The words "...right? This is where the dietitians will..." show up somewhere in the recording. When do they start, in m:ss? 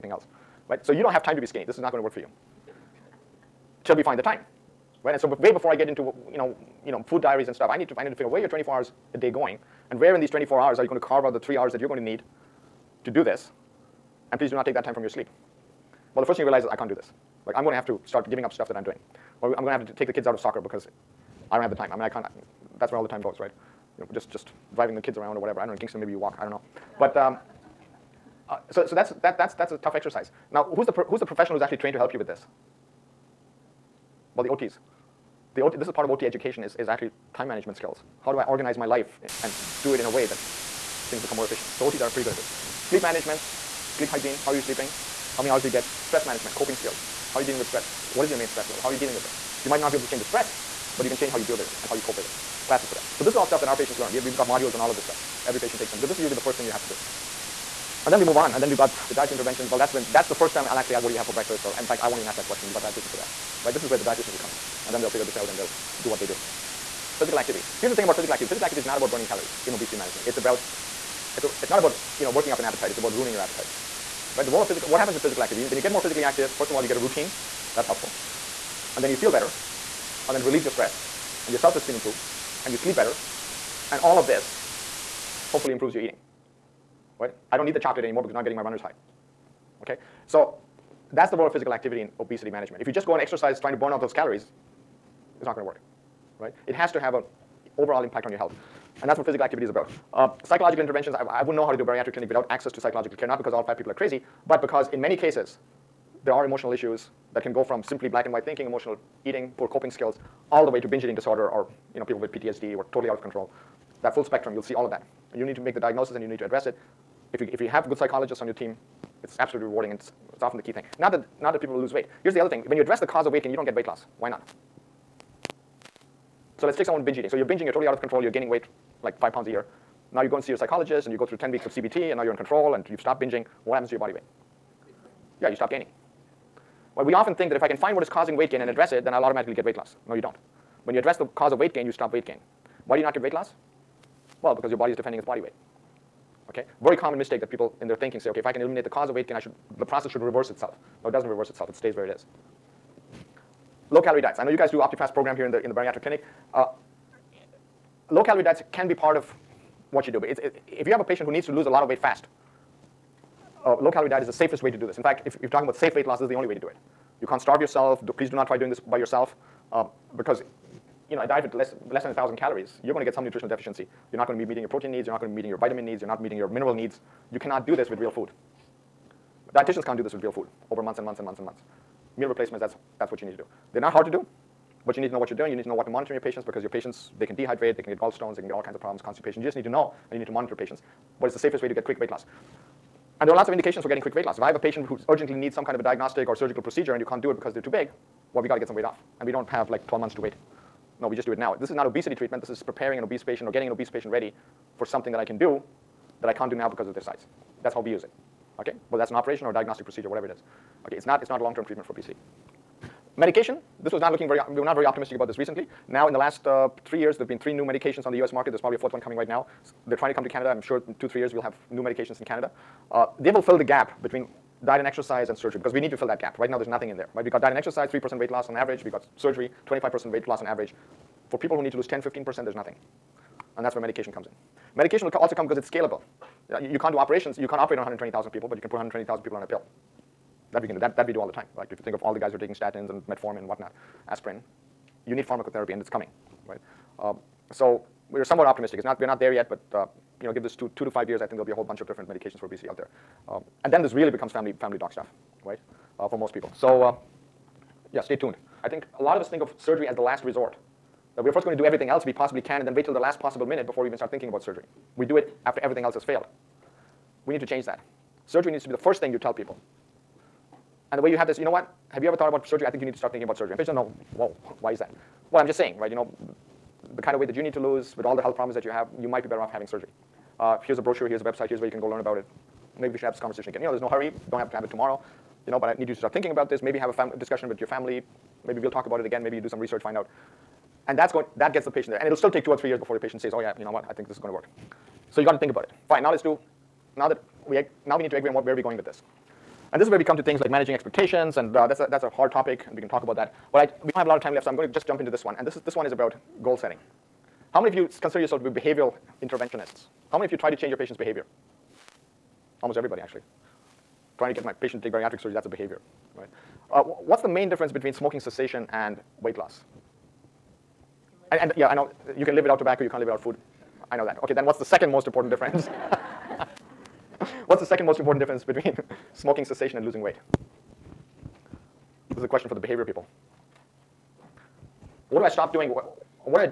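1:03.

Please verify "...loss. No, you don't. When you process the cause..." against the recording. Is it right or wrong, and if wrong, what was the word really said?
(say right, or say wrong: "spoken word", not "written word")
wrong: "address", not "process".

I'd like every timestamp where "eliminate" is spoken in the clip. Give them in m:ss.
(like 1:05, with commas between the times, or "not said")
2:28.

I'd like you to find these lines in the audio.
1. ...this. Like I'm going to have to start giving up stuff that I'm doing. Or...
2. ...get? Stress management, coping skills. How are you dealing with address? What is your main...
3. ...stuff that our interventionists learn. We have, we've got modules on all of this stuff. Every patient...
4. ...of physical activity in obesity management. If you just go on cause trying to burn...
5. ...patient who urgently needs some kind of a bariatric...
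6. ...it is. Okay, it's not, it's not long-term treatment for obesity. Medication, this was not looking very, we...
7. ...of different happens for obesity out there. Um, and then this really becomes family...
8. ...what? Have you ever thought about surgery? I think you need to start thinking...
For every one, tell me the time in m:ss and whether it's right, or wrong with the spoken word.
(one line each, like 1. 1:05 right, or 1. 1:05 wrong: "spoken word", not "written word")
1. 0:16 right
2. 0:45 wrong: "stress", not "address"
3. 0:53 wrong: "patients", not "interventionists"
4. 1:31 wrong: "exercise", not "cause"
5. 3:14 wrong: "diagnostic", not "bariatric"
6. 3:30 right
7. 4:11 wrong: "medications", not "happens"
8. 4:31 right.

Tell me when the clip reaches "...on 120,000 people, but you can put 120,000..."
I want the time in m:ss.
3:57.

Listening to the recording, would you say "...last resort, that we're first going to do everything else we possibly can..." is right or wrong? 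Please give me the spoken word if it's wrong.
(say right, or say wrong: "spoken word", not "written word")
right.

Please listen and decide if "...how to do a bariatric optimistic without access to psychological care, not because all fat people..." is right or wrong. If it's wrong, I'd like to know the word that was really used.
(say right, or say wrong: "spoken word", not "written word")
wrong: "clinic", not "optimistic".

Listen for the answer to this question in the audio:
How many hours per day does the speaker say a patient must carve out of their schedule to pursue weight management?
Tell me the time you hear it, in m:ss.
0:11.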